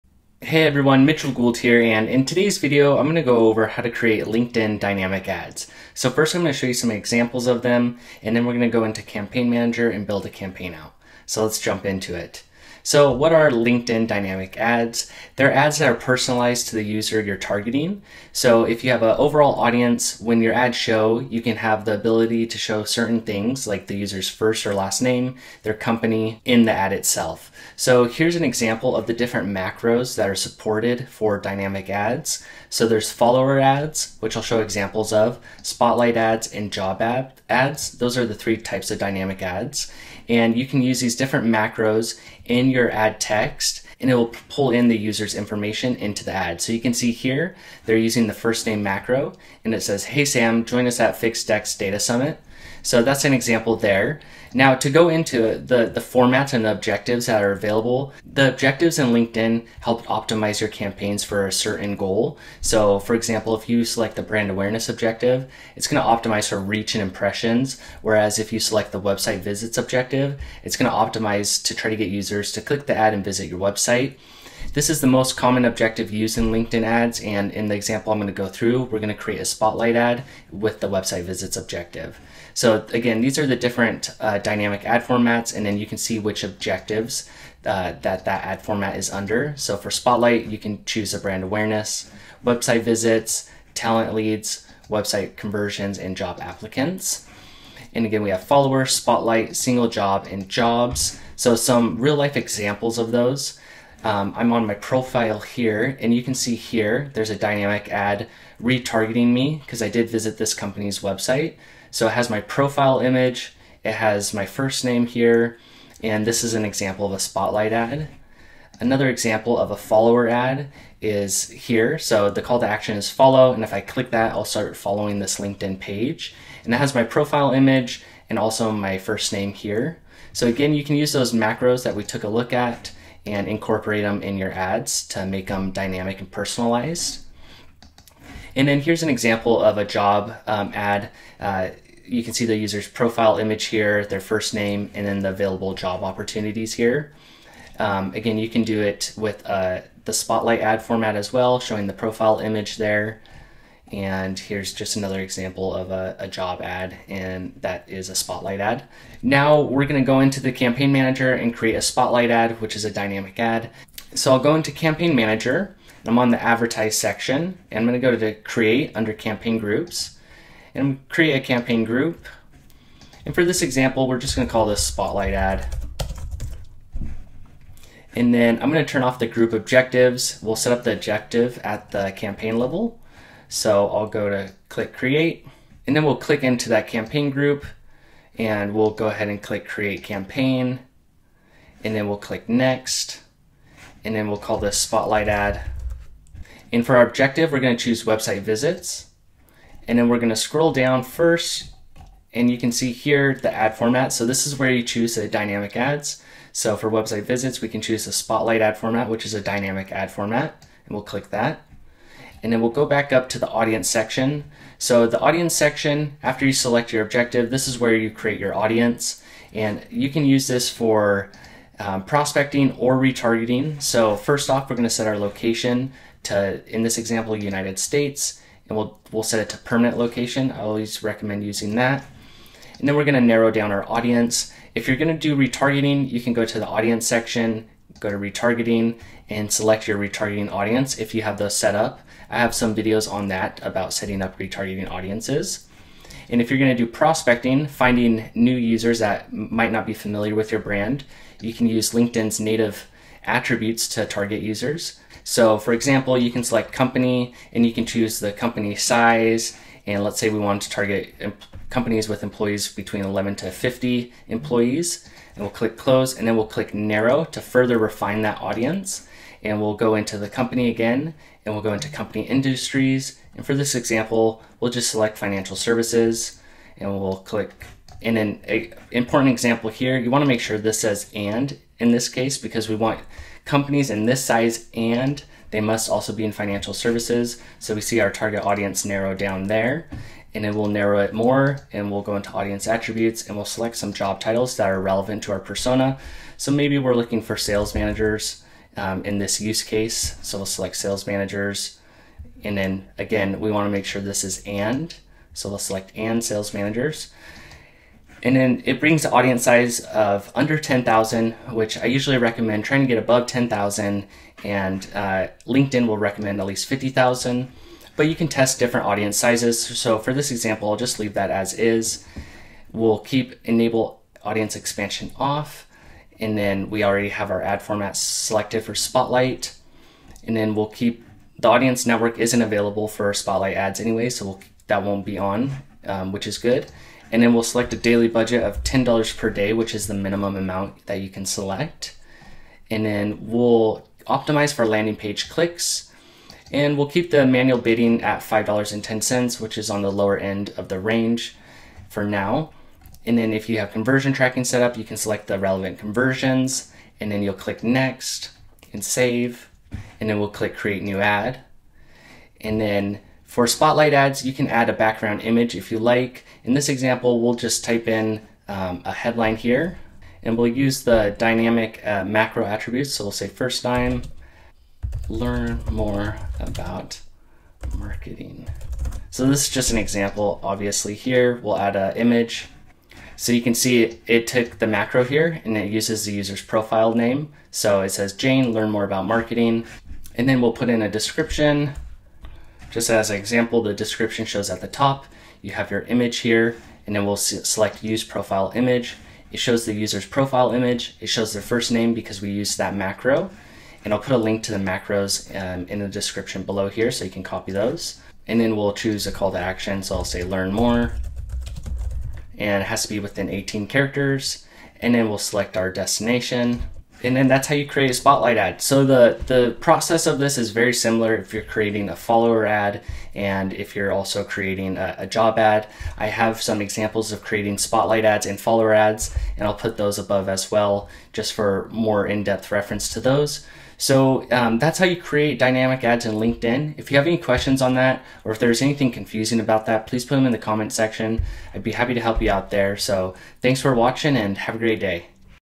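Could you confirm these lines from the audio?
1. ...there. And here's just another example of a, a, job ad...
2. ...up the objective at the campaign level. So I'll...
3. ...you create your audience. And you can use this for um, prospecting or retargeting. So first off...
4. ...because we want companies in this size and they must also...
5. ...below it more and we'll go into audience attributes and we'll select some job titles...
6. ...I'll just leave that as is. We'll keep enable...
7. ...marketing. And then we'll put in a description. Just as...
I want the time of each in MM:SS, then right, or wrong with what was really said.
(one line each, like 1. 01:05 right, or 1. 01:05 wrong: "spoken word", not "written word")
1. 02:32 right
2. 03:00 right
3. 03:37 right
4. 04:42 right
5. 04:50 wrong: "narrow", not "below"
6. 05:20 right
7. 06:29 right.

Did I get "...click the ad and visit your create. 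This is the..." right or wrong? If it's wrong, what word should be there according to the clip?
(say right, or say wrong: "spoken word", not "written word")
wrong: "website", not "create".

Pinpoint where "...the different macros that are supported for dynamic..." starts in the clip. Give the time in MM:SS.
00:29.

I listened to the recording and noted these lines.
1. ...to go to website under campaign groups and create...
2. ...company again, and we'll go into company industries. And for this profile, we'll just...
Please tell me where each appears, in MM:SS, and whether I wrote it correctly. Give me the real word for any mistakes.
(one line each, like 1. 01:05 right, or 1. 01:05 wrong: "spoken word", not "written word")
1. 02:47 wrong: "create", not "website"
2. 04:30 wrong: "example", not "profile".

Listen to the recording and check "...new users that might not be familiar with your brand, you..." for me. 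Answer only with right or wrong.
right.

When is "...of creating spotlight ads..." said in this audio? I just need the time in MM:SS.
07:07.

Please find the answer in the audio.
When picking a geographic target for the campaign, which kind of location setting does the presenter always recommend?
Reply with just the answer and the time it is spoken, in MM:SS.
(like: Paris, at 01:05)
permanent location, at 03:49.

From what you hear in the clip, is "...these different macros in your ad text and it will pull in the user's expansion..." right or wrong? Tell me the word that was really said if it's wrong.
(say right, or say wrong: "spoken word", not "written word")
wrong: "information", not "expansion".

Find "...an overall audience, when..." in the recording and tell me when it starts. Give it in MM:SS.
00:19.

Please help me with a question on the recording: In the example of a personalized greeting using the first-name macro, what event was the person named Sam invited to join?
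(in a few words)
Fixed Dex Data Summit.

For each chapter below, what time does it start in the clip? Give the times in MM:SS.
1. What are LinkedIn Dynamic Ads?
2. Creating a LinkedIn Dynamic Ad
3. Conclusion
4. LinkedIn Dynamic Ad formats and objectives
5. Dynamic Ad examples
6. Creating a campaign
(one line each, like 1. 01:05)
1. 00:12
2. 05:59
3. 07:00
4. 00:54
5. 01:41
6. 02:39.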